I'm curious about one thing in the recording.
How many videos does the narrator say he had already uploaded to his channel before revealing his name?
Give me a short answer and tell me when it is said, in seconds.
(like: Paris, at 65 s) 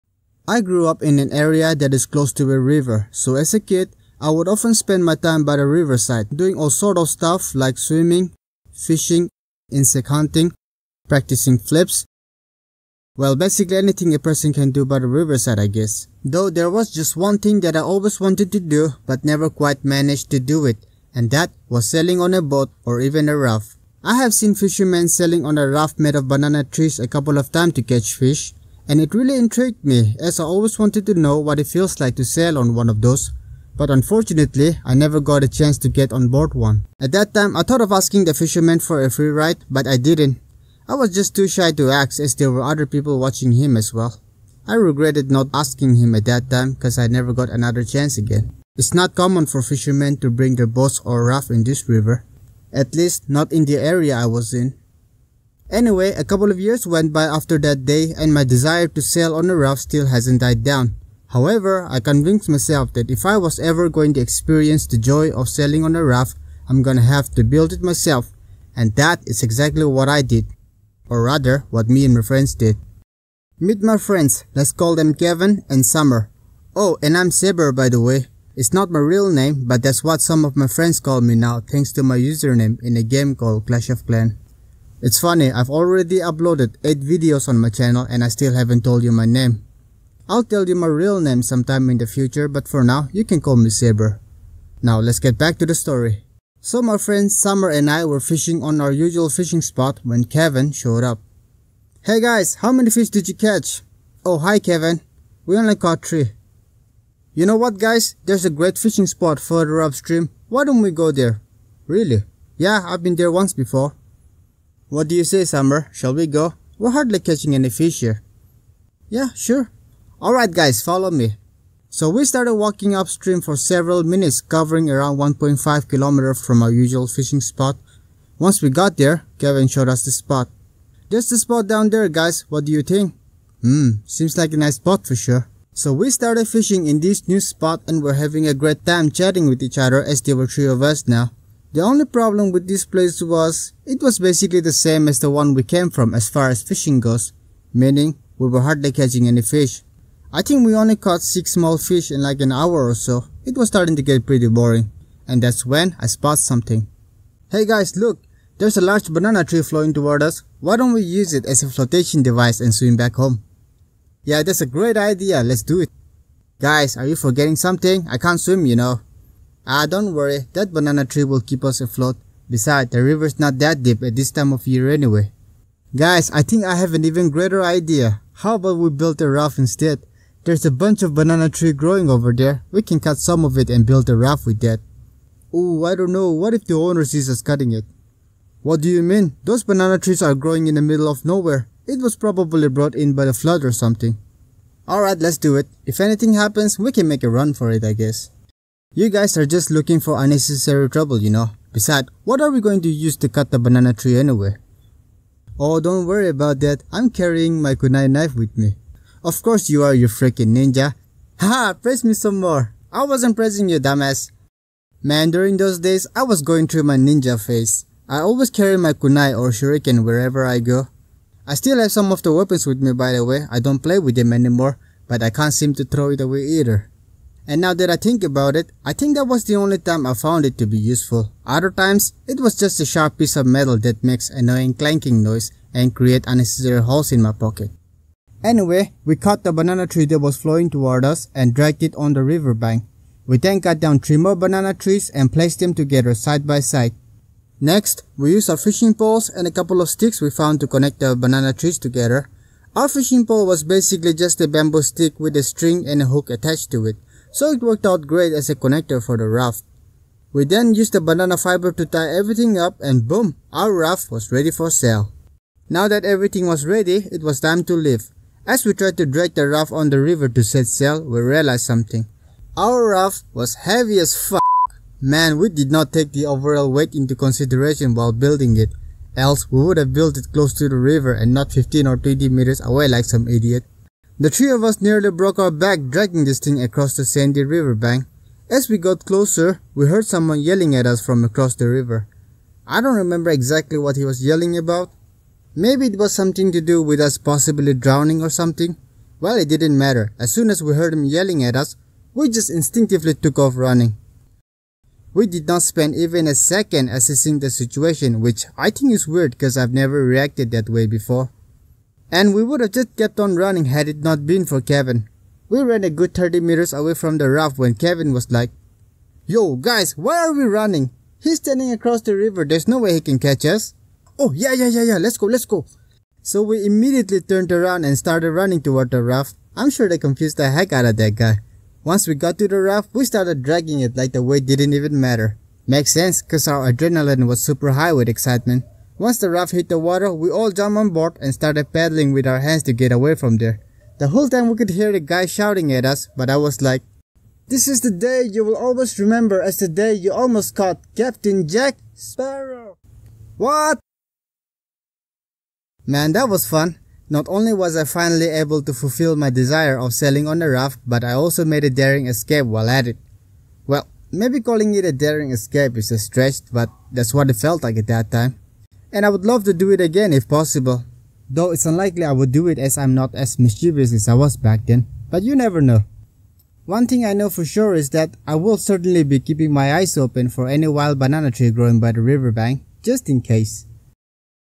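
8, at 86 s.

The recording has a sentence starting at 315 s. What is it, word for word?
We ran a good 30 meters away from the raft when Kevin was like, Yo, guys, why are we running?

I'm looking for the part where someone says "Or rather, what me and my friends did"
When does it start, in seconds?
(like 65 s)
71 s.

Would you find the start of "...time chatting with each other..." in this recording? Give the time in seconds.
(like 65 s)
138 s.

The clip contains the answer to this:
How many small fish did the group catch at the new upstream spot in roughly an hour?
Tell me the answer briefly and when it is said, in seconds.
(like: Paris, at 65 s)
6, at 151 s.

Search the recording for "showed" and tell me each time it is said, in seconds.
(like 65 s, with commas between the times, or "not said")
100 s, 129 s.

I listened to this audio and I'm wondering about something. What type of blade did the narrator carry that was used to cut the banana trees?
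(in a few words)
Kunai knife.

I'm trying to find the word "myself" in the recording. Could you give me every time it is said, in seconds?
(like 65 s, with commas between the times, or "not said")
62 s, 67 s.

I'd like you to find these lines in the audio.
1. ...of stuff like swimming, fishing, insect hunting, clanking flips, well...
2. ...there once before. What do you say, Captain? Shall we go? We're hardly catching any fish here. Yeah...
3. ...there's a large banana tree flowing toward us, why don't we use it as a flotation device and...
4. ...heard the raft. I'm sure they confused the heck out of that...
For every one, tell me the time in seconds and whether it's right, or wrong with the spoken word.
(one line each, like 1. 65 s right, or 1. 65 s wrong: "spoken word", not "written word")
1. 6 s wrong: "practicing", not "clanking"
2. 113 s wrong: "Summer", not "Captain"
3. 158 s right
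4. 328 s wrong: "toward", not "heard".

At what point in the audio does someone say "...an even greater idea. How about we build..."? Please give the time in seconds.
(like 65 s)
176 s.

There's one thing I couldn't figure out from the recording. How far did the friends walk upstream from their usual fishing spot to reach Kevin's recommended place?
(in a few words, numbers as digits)
1.5 kilometers.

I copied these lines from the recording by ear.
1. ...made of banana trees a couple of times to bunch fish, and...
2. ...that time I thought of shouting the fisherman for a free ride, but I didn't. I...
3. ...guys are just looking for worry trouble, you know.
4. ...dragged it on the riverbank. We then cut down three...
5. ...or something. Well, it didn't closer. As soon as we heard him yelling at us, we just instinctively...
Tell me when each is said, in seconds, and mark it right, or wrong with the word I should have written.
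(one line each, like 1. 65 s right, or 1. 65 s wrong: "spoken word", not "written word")
1. 25 s wrong: "catch", not "bunch"
2. 37 s wrong: "asking", not "shouting"
3. 199 s wrong: "unnecessary", not "worry"
4. 241 s right
5. 298 s wrong: "matter", not "closer".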